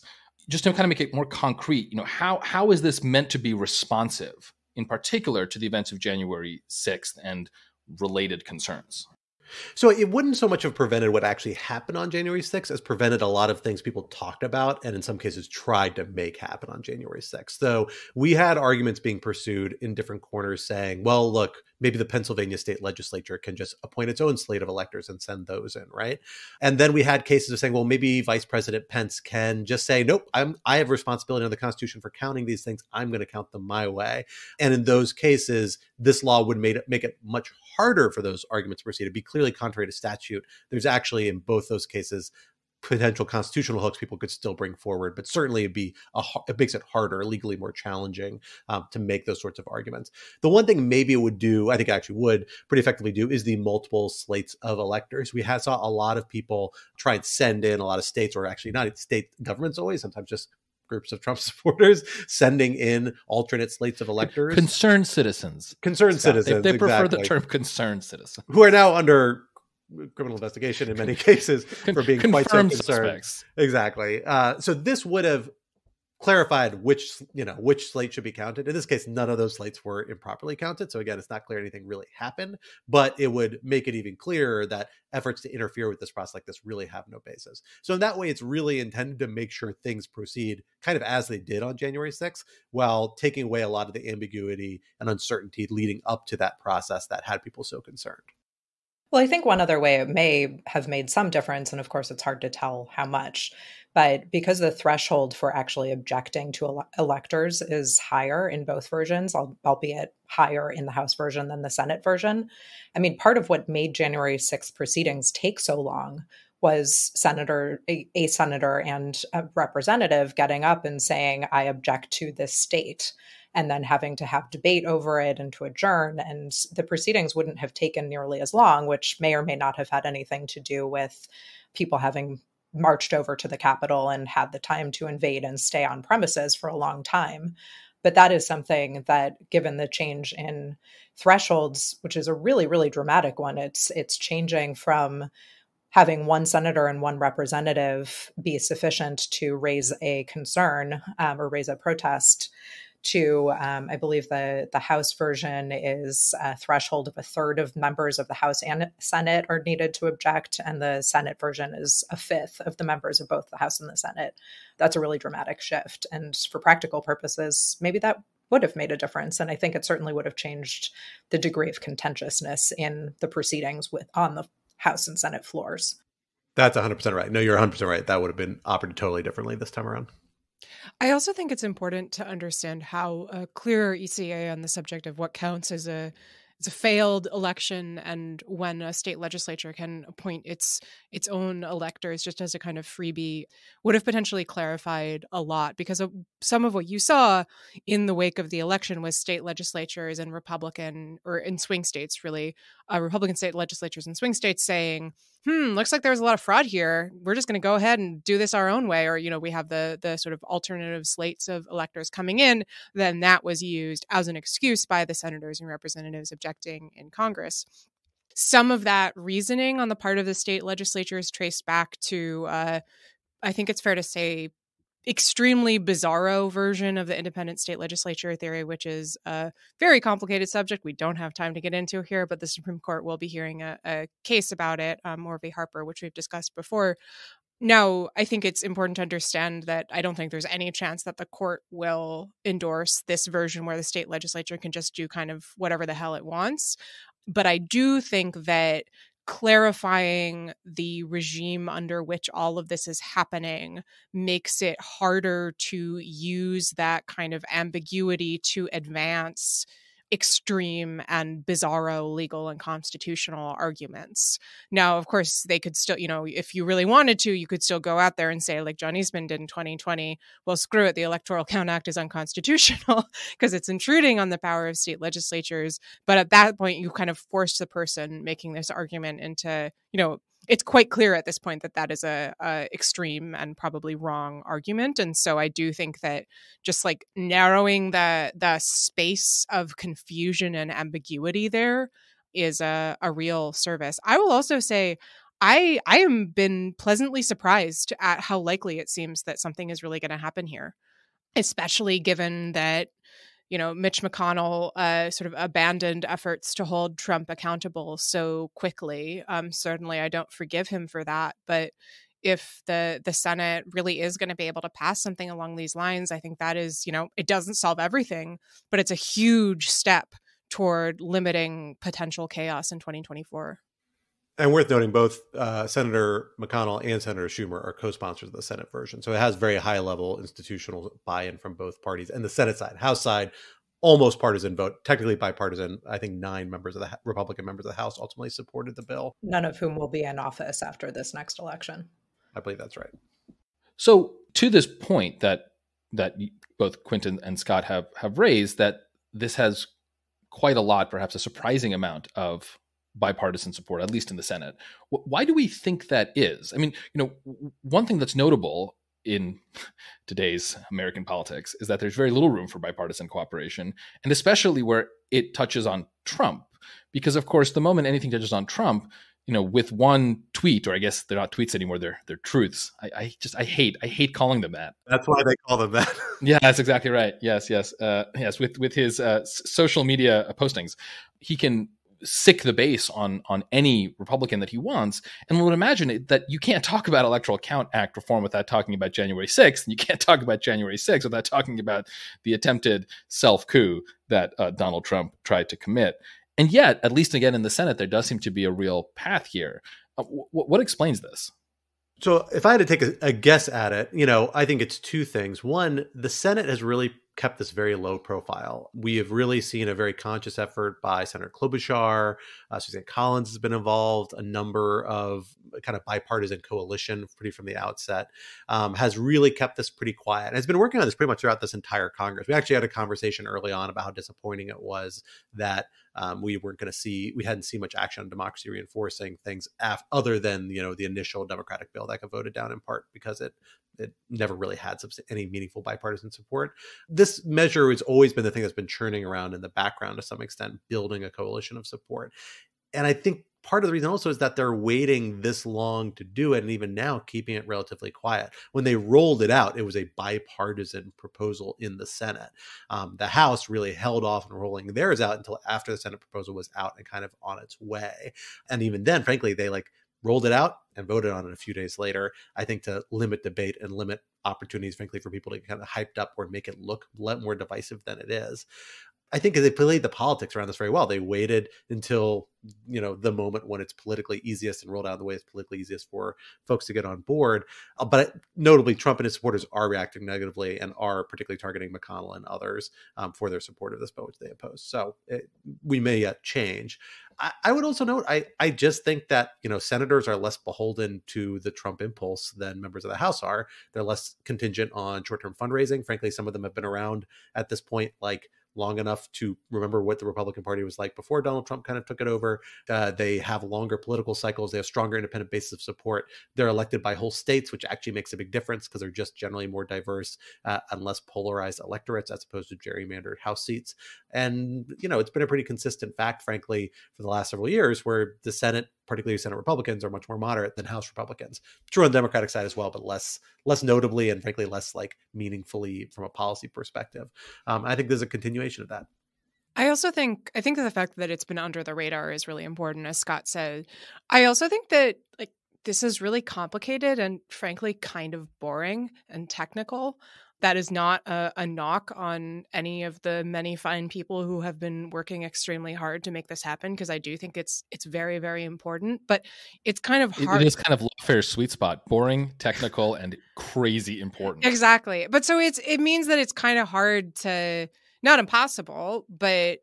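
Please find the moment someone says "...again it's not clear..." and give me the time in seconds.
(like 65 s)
80 s.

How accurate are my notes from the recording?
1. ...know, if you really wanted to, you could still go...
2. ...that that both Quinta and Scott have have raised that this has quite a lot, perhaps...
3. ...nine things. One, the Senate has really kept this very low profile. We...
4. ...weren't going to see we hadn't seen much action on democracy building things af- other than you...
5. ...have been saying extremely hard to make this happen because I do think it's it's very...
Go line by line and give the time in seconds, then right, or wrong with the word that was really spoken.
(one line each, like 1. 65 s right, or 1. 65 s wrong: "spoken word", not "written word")
1. 266 s right
2. 345 s right
3. 404 s wrong: "two", not "nine"
4. 426 s wrong: "reinforcing", not "building"
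5. 544 s wrong: "working", not "saying".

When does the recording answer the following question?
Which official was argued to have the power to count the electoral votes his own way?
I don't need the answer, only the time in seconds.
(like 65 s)
28 s.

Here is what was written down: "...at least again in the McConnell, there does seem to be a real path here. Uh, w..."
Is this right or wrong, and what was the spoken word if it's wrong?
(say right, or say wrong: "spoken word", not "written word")
wrong: "Senate", not "McConnell".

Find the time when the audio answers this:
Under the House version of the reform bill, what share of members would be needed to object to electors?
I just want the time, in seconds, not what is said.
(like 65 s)
157 s.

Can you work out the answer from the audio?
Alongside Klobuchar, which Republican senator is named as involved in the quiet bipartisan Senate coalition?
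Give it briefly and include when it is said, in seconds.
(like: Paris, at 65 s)
Susan Collins, at 412 s.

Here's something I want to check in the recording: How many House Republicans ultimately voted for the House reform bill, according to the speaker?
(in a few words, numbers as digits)
9.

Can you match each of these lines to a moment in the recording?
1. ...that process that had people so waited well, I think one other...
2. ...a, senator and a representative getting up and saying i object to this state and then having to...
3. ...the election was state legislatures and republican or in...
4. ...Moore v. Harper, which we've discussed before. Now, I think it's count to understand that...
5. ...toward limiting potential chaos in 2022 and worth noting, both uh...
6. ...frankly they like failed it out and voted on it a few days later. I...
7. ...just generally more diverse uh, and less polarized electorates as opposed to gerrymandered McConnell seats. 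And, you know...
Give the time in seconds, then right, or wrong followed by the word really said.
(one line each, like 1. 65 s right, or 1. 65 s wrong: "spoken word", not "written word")
1. 96 s wrong: "concerned", not "waited"
2. 118 s right
3. 198 s right
4. 235 s wrong: "important", not "count"
5. 320 s wrong: "2024", not "2022"
6. 459 s wrong: "rolled", not "failed"
7. 508 s wrong: "House", not "McConnell".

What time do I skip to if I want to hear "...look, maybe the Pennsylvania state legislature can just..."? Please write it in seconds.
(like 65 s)
21 s.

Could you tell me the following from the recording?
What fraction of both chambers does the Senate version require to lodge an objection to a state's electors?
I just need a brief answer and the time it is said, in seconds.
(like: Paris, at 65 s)
a fifth, at 162 s.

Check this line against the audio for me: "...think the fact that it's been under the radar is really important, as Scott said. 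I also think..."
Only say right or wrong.
right.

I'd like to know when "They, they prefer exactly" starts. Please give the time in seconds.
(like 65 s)
66 s.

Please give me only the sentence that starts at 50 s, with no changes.
The one thing maybe it would do, I think it actually would pretty effectively do, is the multiple slates of electors.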